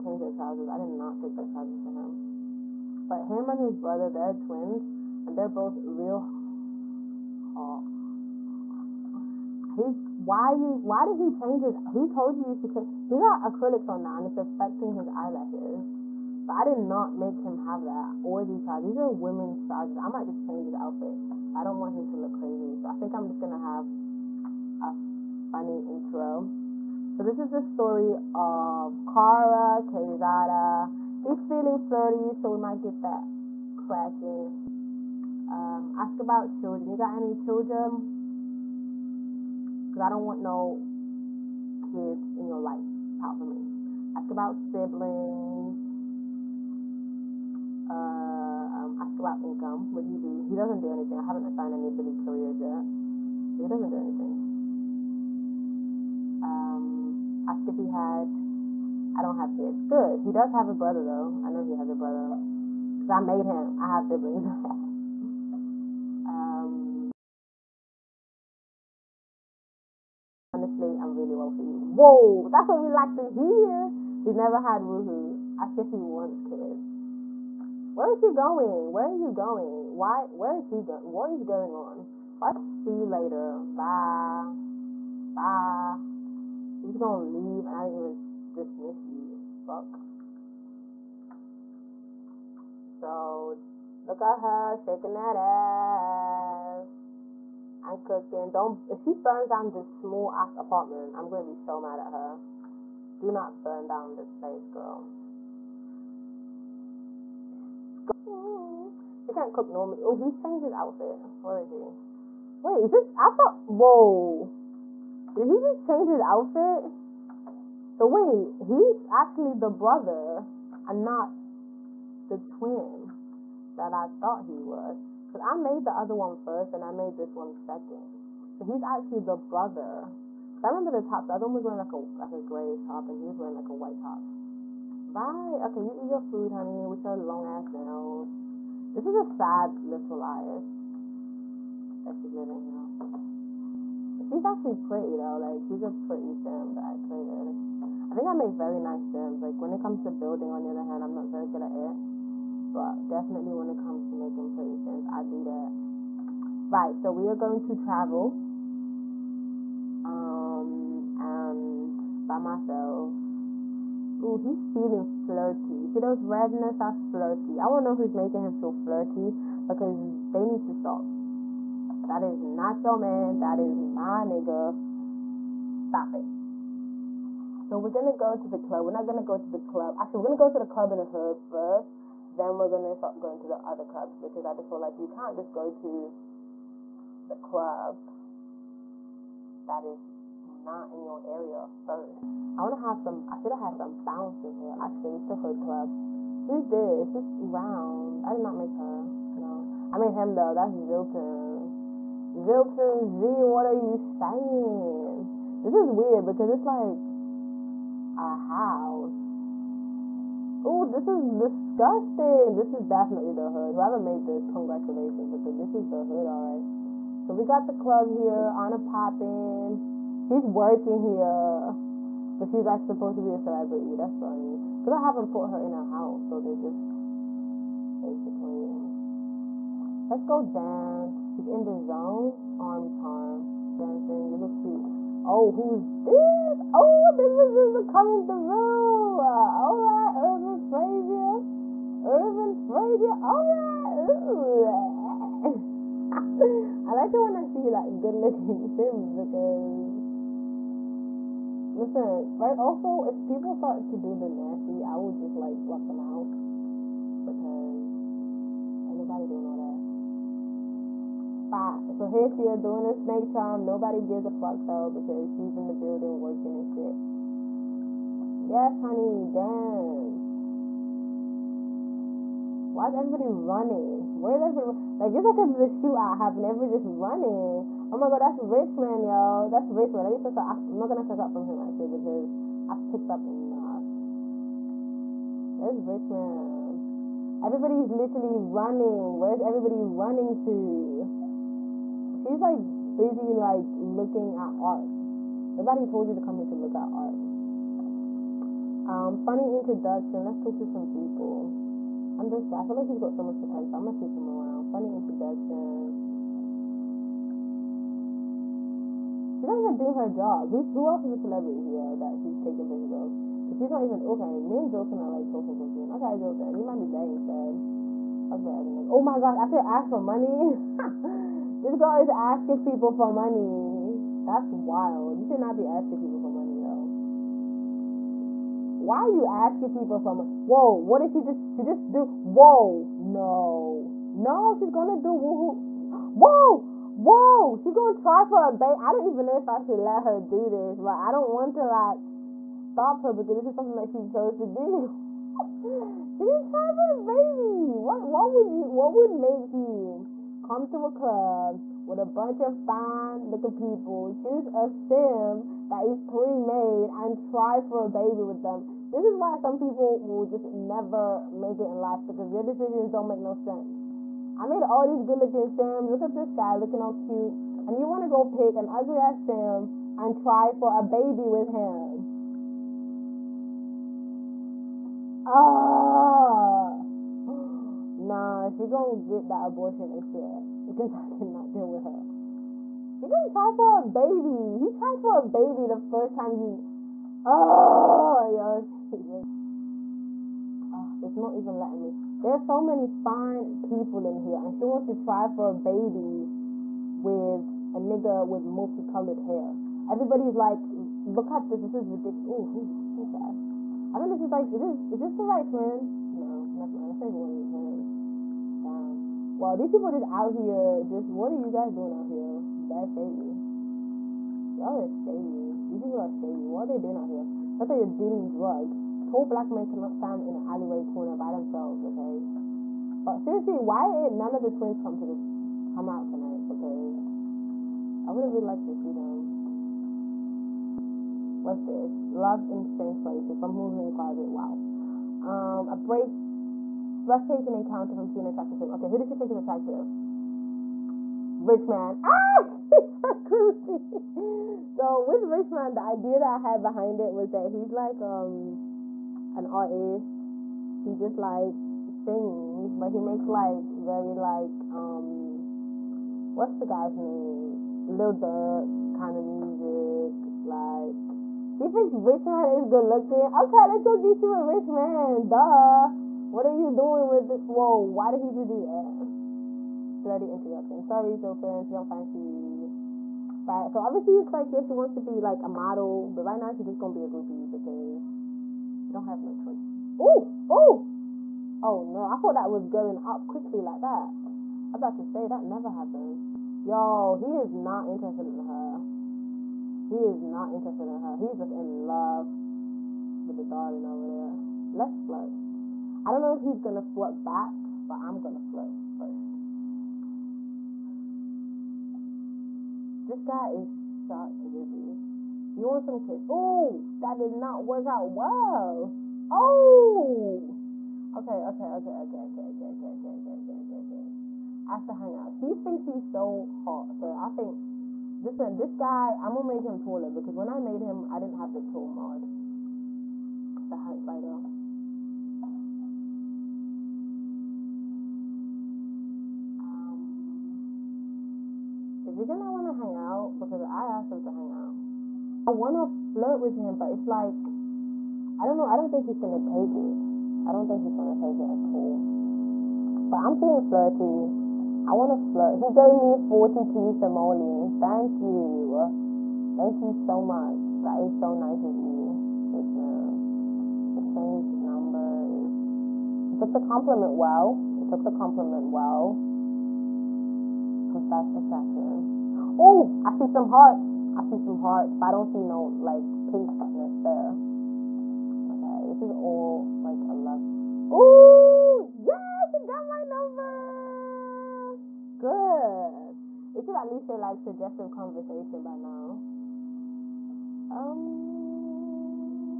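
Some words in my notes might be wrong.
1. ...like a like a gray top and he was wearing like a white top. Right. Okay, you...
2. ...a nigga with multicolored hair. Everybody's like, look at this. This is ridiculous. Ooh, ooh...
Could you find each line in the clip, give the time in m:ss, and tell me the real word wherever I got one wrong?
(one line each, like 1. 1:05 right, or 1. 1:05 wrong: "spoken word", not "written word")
1. 2:11 right
2. 6:37 right.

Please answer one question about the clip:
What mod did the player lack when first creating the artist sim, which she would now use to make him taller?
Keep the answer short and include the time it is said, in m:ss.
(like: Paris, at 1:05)
tall mod, at 8:41.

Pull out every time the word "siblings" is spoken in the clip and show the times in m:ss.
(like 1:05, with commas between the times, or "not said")
0:44, 1:04.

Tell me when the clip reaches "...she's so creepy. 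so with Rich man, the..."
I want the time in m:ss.
7:22.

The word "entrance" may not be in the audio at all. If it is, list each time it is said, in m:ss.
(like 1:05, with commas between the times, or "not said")
not said.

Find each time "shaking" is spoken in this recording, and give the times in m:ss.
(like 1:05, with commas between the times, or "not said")
1:34.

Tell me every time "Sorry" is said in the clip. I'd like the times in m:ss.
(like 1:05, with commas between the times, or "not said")
7:50.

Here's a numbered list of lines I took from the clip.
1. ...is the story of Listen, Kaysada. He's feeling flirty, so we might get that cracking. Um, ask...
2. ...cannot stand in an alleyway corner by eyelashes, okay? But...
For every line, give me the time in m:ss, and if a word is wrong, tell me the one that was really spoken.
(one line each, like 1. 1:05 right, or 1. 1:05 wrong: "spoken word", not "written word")
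1. 0:27 wrong: "Kara", not "Listen"
2. 6:59 wrong: "themselves", not "eyelashes".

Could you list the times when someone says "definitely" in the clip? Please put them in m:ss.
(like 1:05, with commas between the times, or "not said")
2:33, 3:32.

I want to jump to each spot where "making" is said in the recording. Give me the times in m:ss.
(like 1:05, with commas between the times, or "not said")
2:34, 2:48.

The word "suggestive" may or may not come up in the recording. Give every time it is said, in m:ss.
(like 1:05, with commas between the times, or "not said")
9:37.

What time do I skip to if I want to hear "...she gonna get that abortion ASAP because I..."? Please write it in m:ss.
6:18.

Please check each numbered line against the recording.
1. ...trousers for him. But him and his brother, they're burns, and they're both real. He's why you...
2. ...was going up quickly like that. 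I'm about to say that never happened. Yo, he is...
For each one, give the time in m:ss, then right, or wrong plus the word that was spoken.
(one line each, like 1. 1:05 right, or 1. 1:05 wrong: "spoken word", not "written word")
1. 0:01 wrong: "twins", not "burns"
2. 8:02 right.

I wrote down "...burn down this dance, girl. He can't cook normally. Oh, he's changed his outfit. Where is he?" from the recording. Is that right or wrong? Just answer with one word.
wrong.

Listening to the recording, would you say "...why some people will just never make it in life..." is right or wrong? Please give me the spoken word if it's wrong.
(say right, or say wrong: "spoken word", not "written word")
right.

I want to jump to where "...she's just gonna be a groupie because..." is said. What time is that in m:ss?
7:56.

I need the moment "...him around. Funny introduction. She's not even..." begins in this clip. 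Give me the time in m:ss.
5:04.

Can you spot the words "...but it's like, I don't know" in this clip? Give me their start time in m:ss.
8:56.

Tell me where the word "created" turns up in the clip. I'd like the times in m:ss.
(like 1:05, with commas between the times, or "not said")
2:27.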